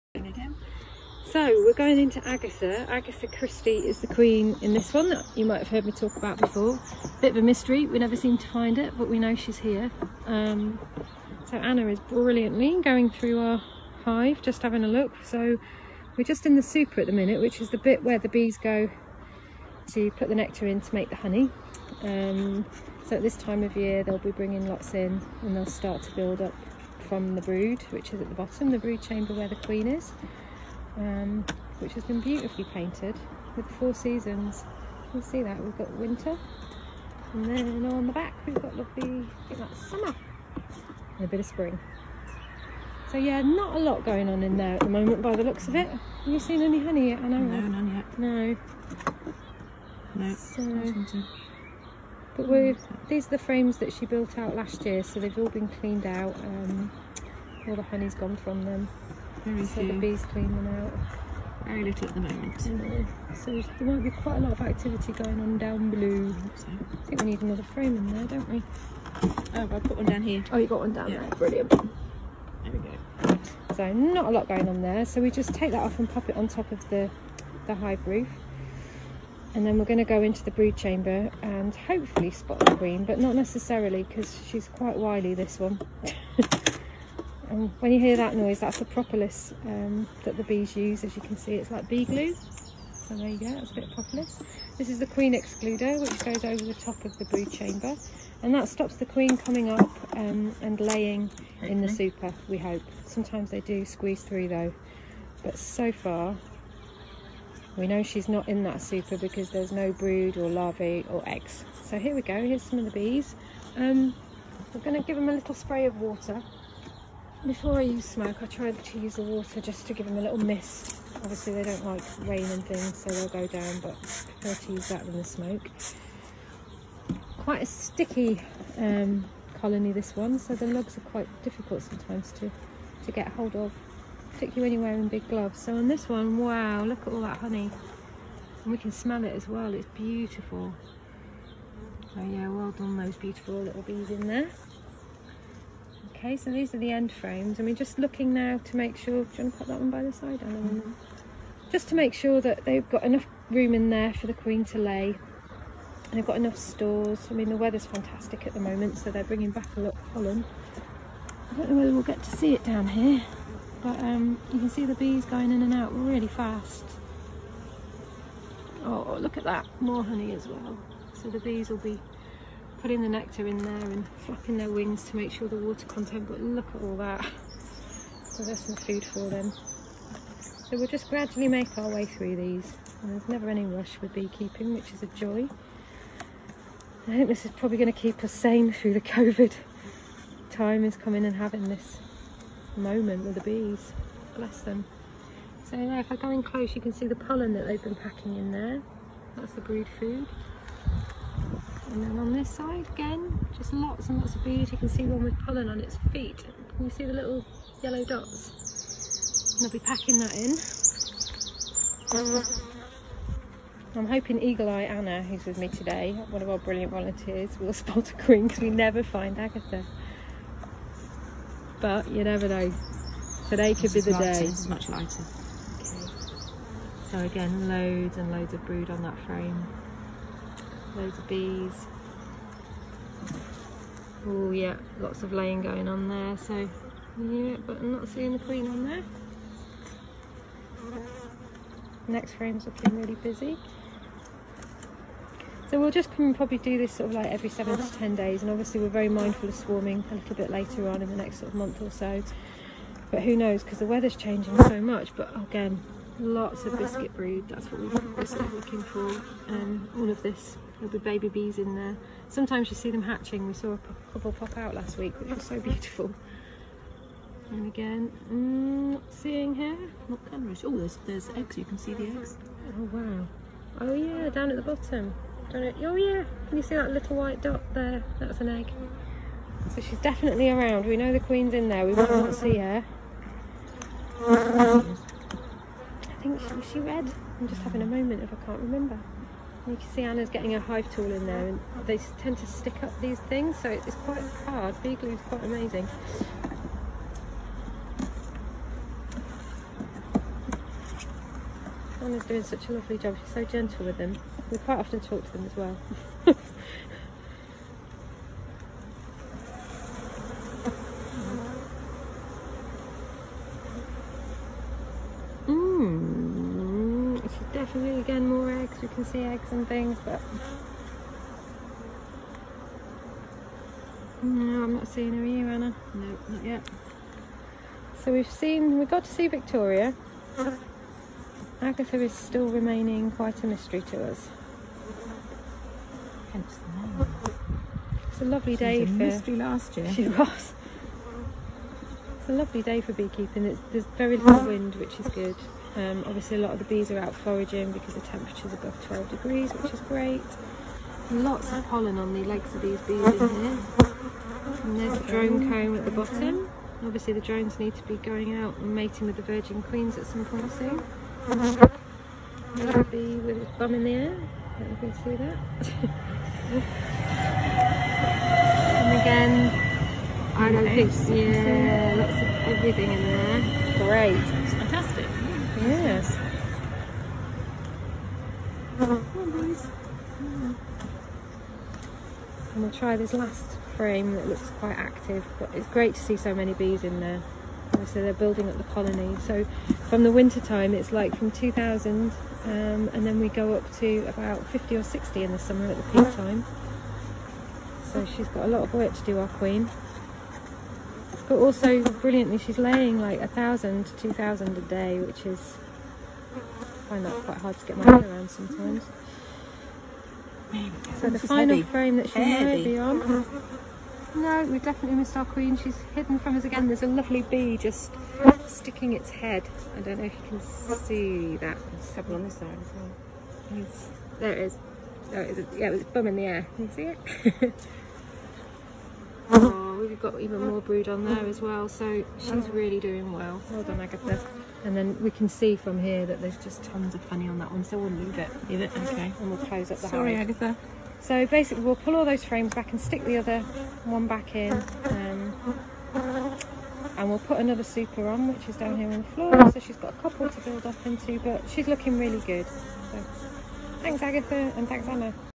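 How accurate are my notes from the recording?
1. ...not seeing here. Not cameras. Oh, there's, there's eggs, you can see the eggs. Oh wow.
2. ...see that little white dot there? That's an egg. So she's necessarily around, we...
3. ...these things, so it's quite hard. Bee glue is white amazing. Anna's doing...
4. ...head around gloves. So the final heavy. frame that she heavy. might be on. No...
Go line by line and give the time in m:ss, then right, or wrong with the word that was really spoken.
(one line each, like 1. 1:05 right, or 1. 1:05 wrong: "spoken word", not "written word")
1. 4:28 right
2. 4:36 wrong: "definitely", not "necessarily"
3. 4:52 wrong: "quite", not "white"
4. 6:47 wrong: "sometimes", not "gloves".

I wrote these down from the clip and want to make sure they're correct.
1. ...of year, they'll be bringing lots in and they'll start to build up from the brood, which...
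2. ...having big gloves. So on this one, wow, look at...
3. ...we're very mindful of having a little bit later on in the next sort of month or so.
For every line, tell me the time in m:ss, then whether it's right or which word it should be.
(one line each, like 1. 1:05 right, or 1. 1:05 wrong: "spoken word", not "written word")
1. 0:23 right
2. 2:14 wrong: "wearing", not "having"
3. 4:08 wrong: "swarming", not "having".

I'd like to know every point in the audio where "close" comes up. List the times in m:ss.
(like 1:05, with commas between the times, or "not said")
3:16, 7:19.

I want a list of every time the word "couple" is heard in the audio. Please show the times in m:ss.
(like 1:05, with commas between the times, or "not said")
4:24, 7:30.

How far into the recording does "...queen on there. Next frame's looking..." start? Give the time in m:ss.
3:58.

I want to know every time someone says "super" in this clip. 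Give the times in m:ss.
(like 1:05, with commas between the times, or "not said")
0:16, 1:41, 1:48, 7:27.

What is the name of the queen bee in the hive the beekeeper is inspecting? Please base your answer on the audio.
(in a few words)
Agatha Christie.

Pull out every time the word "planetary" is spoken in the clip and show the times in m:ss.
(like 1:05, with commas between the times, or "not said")
not said.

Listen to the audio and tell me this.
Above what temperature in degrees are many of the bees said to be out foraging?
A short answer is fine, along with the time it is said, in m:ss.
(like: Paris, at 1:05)
12 degrees, at 5:48.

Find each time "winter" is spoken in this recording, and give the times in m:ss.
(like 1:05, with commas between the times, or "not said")
0:35, 6:30.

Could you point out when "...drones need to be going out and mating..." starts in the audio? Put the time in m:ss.
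5:57.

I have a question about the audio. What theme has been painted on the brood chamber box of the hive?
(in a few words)
The four seasons.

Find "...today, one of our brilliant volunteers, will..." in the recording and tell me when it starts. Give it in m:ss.
3:35.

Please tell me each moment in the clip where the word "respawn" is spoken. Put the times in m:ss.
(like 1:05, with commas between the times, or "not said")
not said.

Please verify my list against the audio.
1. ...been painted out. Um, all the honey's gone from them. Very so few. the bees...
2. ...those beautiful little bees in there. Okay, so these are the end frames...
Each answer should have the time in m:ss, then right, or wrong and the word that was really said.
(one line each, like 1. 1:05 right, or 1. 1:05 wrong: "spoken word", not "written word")
1. 0:55 wrong: "cleaned", not "painted"
2. 2:22 right.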